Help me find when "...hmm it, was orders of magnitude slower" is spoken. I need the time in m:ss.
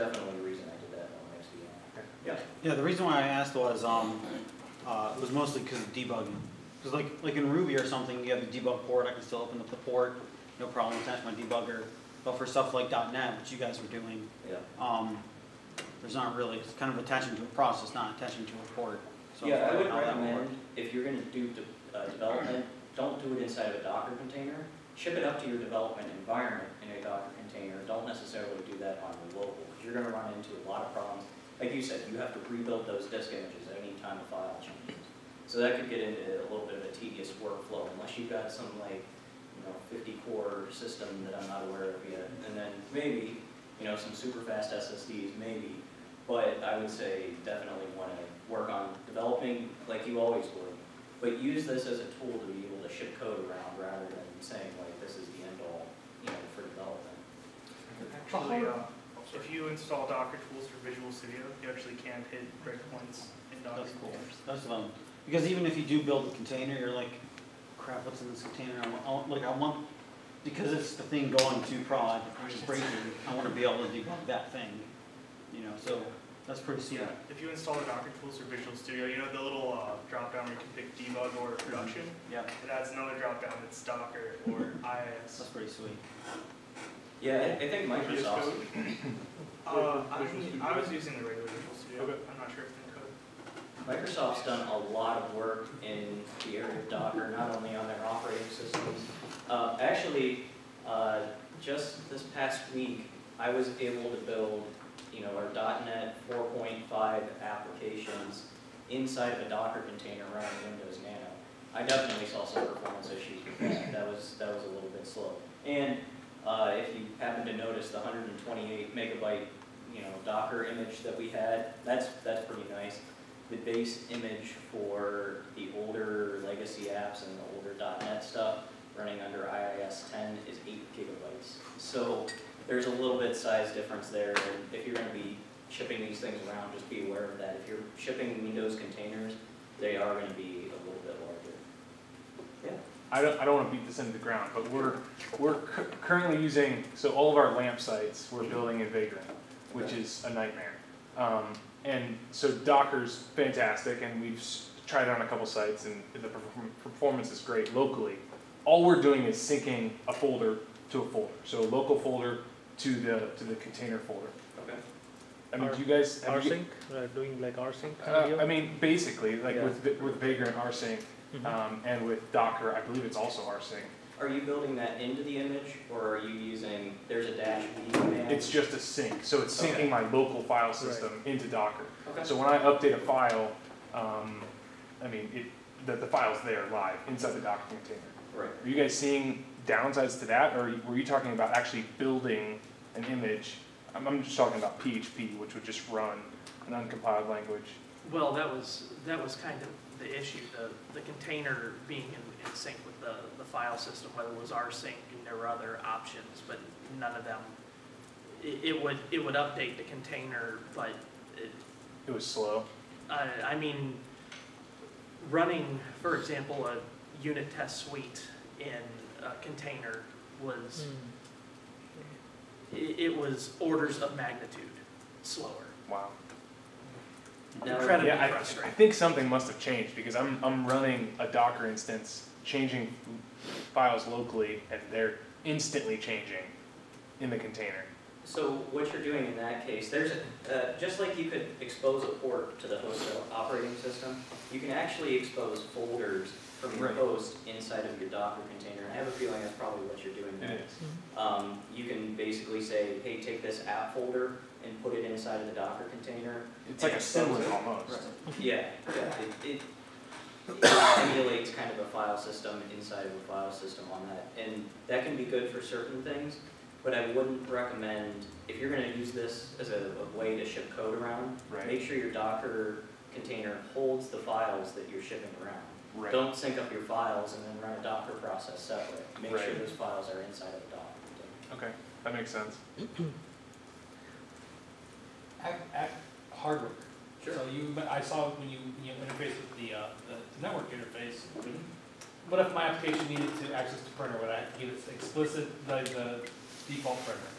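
3:40.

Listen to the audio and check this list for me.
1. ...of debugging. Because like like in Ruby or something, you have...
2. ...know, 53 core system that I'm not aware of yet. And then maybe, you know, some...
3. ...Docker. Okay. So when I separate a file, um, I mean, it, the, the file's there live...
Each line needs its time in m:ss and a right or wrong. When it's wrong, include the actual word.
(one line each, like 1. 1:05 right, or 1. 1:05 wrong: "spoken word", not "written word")
1. 0:05 right
2. 0:39 wrong: "50", not "53"
3. 3:01 wrong: "update", not "separate".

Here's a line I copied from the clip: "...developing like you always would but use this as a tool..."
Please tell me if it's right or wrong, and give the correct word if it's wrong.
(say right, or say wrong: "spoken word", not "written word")
right.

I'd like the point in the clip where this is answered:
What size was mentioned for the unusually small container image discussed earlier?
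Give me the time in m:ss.
1:57.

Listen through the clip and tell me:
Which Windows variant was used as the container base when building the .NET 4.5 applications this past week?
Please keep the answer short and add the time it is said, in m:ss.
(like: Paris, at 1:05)
Windows Nano, at 1:50.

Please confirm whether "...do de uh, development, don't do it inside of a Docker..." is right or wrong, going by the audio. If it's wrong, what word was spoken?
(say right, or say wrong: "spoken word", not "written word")
right.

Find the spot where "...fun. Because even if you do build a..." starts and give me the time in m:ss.
1:04.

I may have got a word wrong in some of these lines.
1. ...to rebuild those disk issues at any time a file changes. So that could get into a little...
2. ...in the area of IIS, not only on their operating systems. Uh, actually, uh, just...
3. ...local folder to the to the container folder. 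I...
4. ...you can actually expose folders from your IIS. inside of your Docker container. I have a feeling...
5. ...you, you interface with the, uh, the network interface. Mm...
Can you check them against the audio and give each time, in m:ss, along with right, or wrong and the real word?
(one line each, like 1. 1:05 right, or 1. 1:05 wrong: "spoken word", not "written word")
1. 0:32 wrong: "images", not "issues"
2. 1:35 wrong: "Docker", not "IIS"
3. 2:41 right
4. 4:04 wrong: "Right", not "IIS"
5. 4:48 right.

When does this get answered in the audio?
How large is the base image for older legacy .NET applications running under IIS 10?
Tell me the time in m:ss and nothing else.
2:10.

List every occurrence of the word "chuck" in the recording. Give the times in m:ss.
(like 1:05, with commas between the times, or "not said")
not said.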